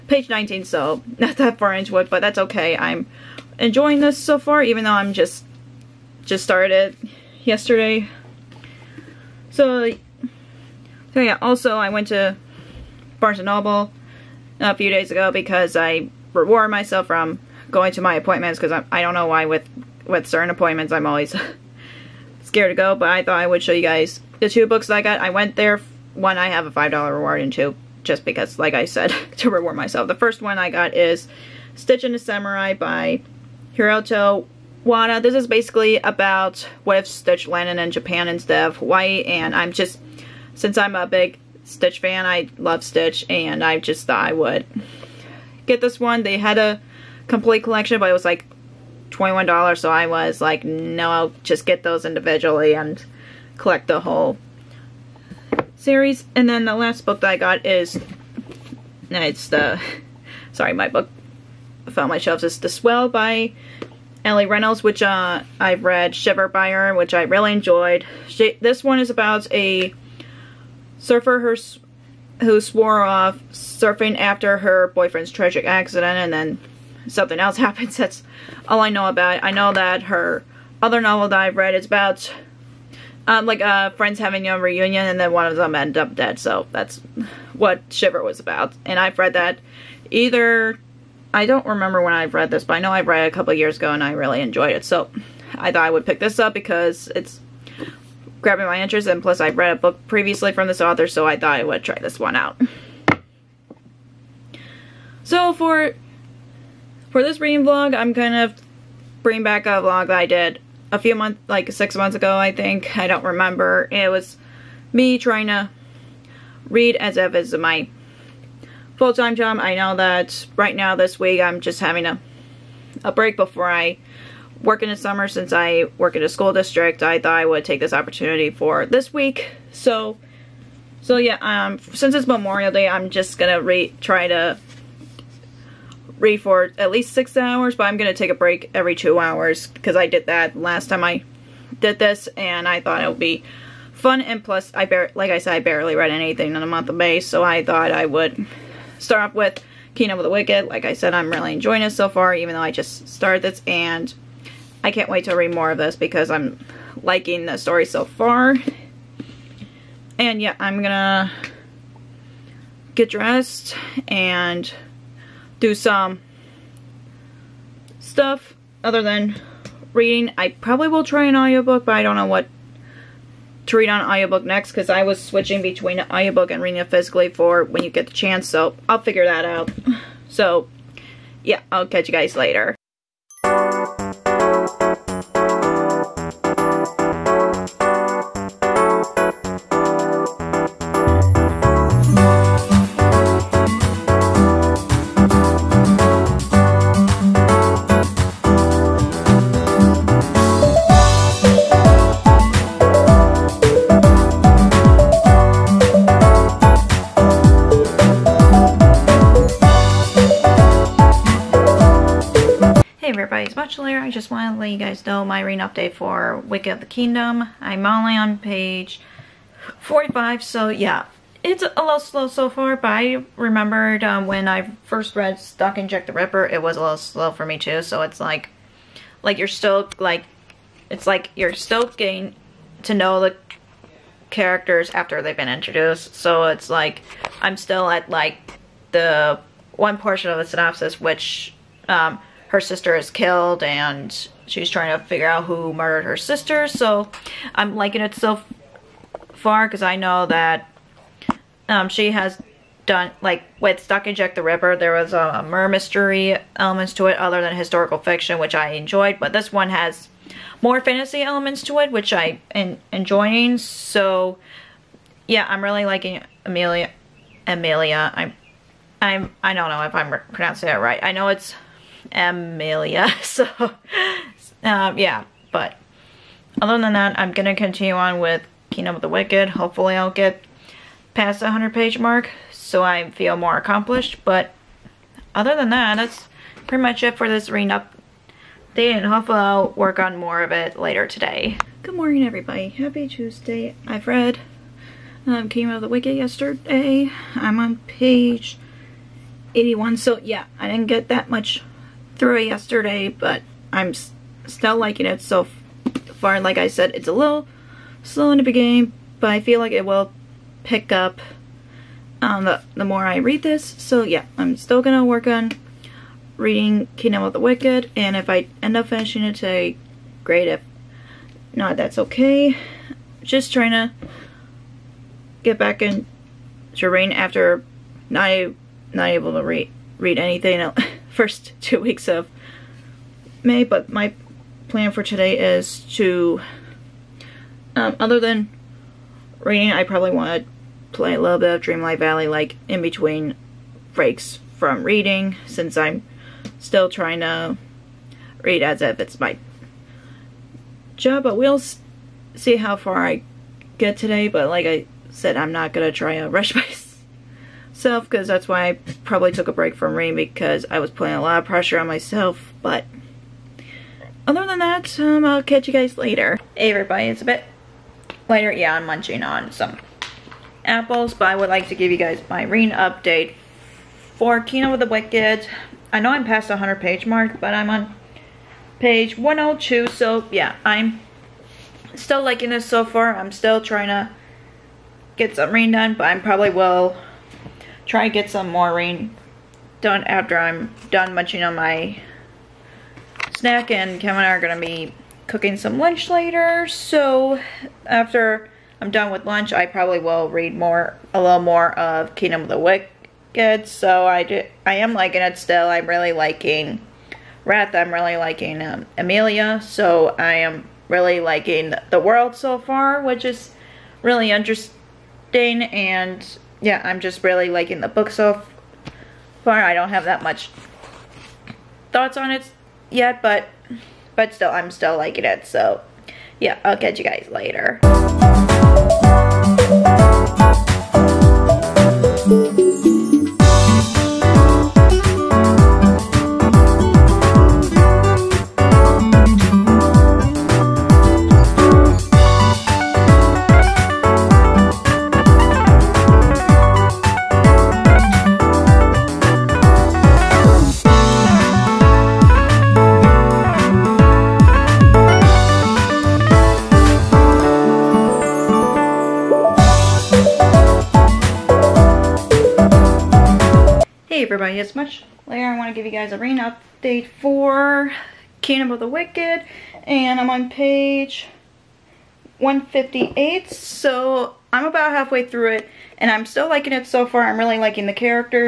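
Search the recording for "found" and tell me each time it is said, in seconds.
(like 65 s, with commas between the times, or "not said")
61 s.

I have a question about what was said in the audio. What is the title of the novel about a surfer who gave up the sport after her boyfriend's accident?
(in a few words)
The Swell.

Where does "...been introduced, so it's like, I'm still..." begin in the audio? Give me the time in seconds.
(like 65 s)
235 s.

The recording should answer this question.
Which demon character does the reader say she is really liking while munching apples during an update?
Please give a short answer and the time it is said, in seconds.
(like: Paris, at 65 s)
Wrath, at 407 s.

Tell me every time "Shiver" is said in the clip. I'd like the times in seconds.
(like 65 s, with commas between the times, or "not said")
66 s, 87 s.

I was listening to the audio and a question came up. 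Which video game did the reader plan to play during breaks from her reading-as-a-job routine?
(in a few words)
Dreamlight Valley.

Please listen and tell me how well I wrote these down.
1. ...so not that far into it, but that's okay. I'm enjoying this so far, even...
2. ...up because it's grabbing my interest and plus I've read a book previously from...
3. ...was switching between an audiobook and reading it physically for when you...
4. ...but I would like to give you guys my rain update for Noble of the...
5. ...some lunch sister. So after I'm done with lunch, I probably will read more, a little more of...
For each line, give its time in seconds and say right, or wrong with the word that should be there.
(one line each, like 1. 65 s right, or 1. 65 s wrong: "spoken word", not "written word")
1. 0 s right
2. 96 s right
3. 175 s right
4. 371 s wrong: "Kingdom", not "Noble"
5. 395 s wrong: "later", not "sister".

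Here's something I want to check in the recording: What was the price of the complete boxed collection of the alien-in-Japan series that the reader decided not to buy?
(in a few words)
$21.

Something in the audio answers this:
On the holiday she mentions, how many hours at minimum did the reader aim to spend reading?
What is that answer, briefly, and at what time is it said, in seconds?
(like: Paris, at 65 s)
6, at 137 s.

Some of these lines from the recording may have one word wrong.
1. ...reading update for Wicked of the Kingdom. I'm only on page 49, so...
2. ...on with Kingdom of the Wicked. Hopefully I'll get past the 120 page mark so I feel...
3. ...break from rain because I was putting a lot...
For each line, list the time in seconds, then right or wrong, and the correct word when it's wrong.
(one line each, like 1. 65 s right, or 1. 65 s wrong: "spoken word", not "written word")
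1. 215 s wrong: "45", not "49"
2. 277 s wrong: "100", not "120"
3. 359 s right.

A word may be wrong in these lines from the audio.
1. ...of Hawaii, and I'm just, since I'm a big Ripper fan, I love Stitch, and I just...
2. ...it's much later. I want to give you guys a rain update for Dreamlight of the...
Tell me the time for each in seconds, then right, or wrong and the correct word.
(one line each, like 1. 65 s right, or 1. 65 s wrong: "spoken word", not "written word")
1. 38 s wrong: "Stitch", not "Ripper"
2. 464 s wrong: "Kingdom", not "Dreamlight".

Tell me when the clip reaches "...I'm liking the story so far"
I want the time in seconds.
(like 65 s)
156 s.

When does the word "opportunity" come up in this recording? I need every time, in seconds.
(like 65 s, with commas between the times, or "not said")
127 s.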